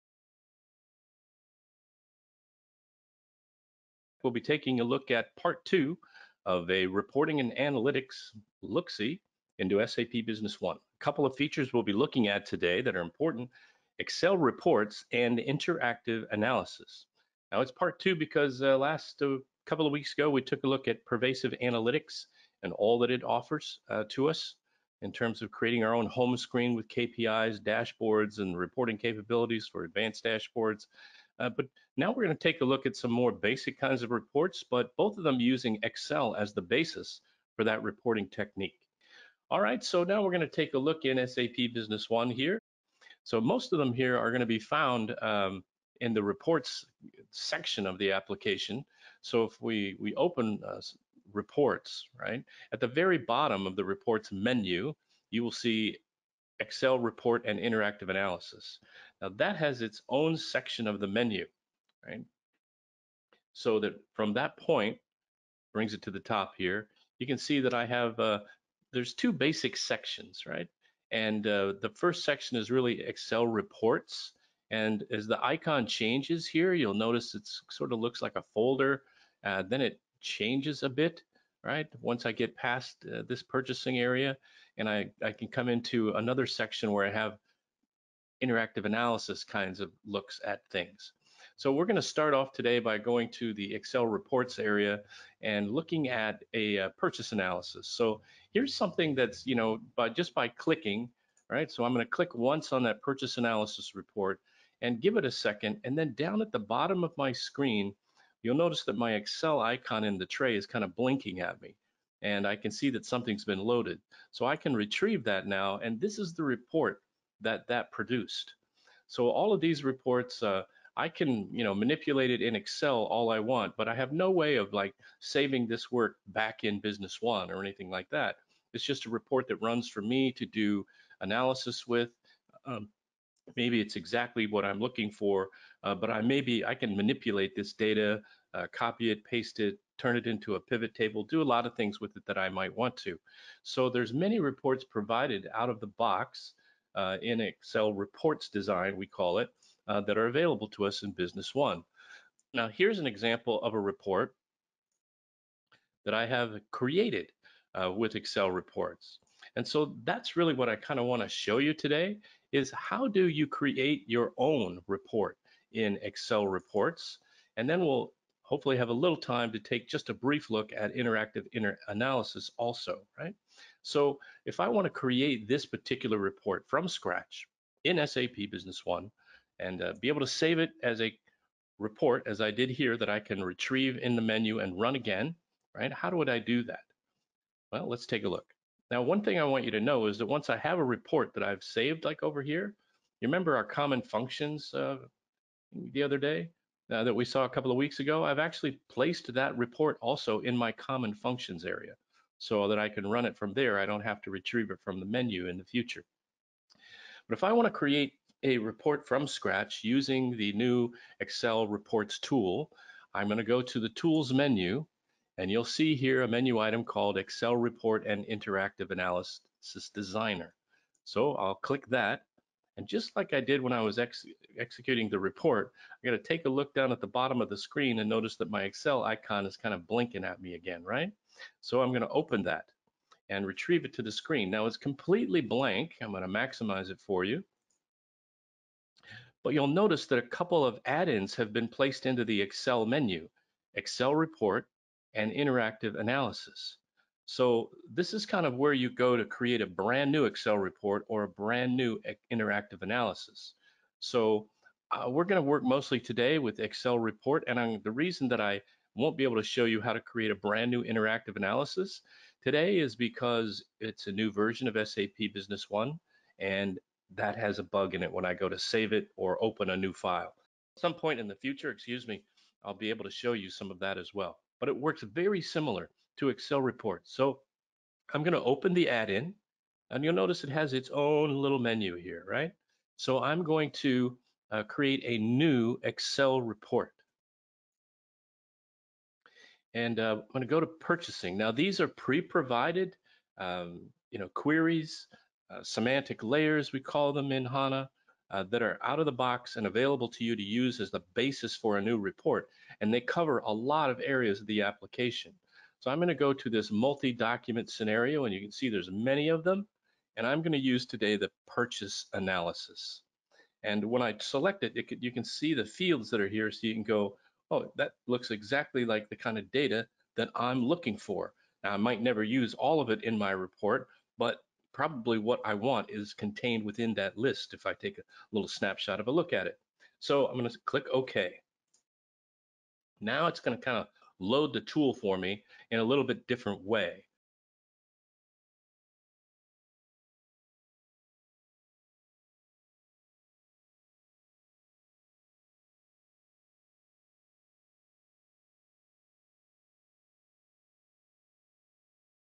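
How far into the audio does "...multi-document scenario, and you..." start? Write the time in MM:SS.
05:06.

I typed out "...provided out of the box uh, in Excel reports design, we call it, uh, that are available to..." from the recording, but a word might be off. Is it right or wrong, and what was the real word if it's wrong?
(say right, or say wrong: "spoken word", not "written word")
right.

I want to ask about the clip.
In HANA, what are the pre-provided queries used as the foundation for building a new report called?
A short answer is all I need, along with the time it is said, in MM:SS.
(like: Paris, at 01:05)
semantic layers, at 04:55.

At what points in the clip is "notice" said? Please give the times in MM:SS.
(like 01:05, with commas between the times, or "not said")
01:16, 01:48, 03:48, 03:59, 04:40.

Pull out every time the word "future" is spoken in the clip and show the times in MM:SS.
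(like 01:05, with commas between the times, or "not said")
03:25, 04:31.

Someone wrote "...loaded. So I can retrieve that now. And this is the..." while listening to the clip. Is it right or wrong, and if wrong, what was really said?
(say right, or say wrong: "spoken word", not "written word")
right.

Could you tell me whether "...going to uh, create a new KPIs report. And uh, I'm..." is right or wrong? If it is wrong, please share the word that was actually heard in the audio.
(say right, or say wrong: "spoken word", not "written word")
wrong: "Excel", not "KPIs".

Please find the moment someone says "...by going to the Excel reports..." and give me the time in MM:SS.
01:32.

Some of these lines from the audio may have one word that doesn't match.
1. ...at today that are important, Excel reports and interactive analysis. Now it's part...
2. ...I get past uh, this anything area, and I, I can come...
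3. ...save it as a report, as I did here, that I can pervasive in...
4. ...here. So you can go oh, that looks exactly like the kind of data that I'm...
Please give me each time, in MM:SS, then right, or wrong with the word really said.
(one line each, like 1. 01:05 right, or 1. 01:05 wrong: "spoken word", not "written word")
1. 00:12 right
2. 01:22 wrong: "purchasing", not "anything"
3. 03:00 wrong: "retrieve", not "pervasive"
4. 05:16 right.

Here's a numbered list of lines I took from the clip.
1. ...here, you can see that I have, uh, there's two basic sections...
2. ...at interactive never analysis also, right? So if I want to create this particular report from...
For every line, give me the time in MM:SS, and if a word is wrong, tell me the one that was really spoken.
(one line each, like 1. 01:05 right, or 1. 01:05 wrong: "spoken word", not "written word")
1. 01:06 right
2. 02:50 wrong: "inter", not "never".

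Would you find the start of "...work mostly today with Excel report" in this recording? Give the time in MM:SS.
04:15.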